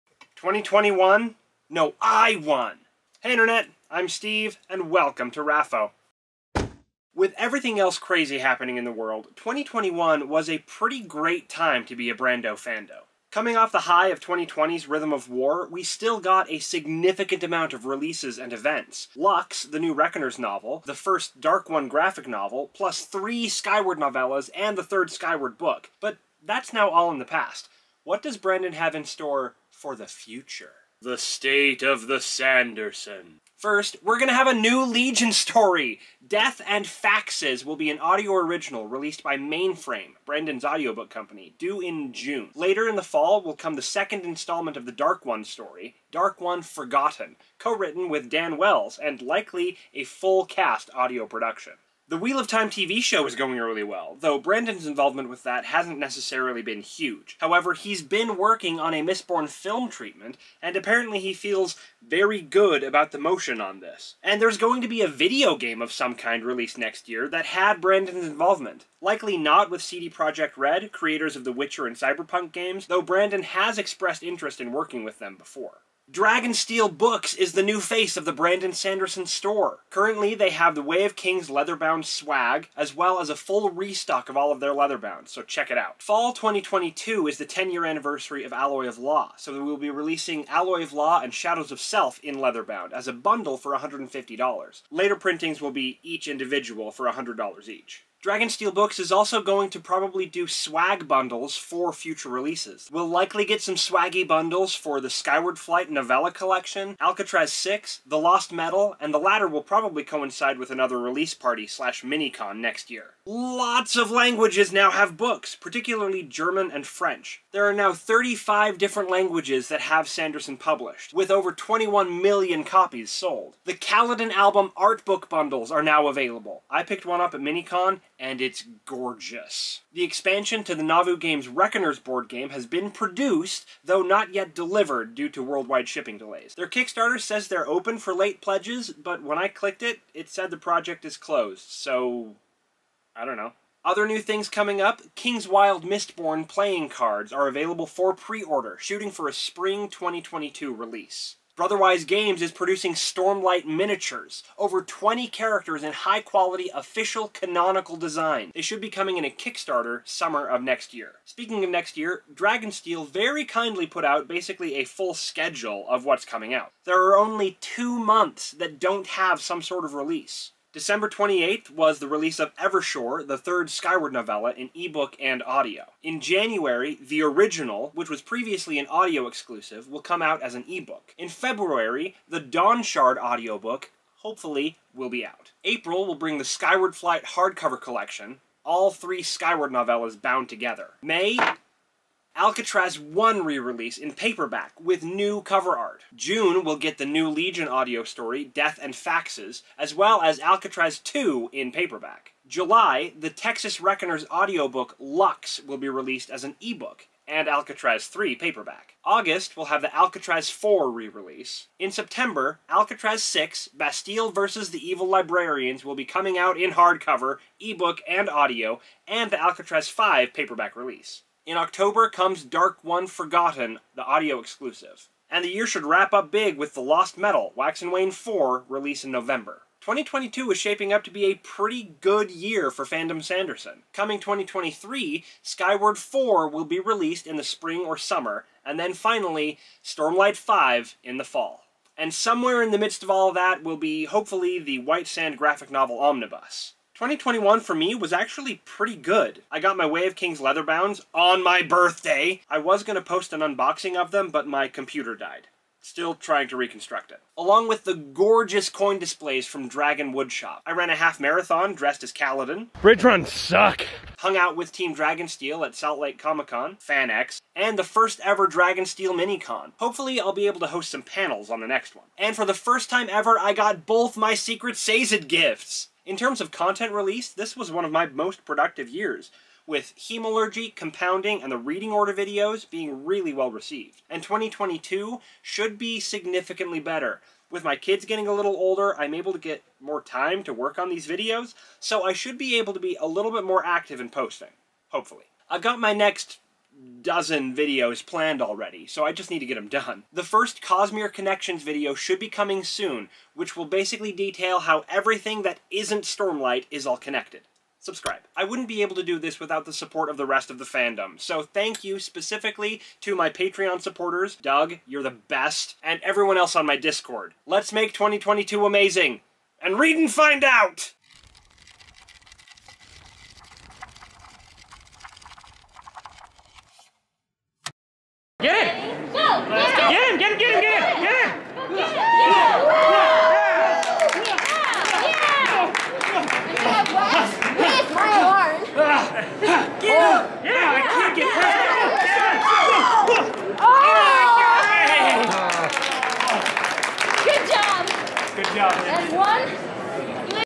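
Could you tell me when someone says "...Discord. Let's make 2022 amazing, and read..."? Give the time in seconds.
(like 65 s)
316 s.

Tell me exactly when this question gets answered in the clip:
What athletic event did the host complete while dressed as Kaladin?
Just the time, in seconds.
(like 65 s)
260 s.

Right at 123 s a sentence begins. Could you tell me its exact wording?
The Kaladin album art book bundles are now available.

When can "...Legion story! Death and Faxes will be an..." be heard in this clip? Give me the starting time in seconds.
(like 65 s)
34 s.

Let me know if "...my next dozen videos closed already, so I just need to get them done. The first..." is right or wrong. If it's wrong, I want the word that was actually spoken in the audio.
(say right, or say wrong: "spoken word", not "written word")
wrong: "planned", not "closed".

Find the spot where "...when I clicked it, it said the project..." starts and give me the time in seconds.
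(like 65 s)
139 s.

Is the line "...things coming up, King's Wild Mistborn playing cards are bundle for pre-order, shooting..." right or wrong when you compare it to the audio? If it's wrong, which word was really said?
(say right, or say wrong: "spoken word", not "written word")
wrong: "available", not "bundle".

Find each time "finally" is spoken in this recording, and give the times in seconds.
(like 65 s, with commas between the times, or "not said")
238 s.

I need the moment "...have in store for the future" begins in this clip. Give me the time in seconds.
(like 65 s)
28 s.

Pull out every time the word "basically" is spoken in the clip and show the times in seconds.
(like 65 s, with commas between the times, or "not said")
164 s, 303 s.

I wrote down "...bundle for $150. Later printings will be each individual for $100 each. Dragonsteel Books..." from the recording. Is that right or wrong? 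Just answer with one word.
right.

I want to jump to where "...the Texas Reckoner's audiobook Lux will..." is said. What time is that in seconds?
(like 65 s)
203 s.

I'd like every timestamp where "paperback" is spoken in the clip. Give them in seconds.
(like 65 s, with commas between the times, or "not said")
194 s, 201 s, 208 s, 220 s.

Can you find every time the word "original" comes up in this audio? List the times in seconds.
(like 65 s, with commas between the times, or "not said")
38 s, 177 s.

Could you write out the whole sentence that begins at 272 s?
And for the first time ever, I got both my Secret Sazed gifts.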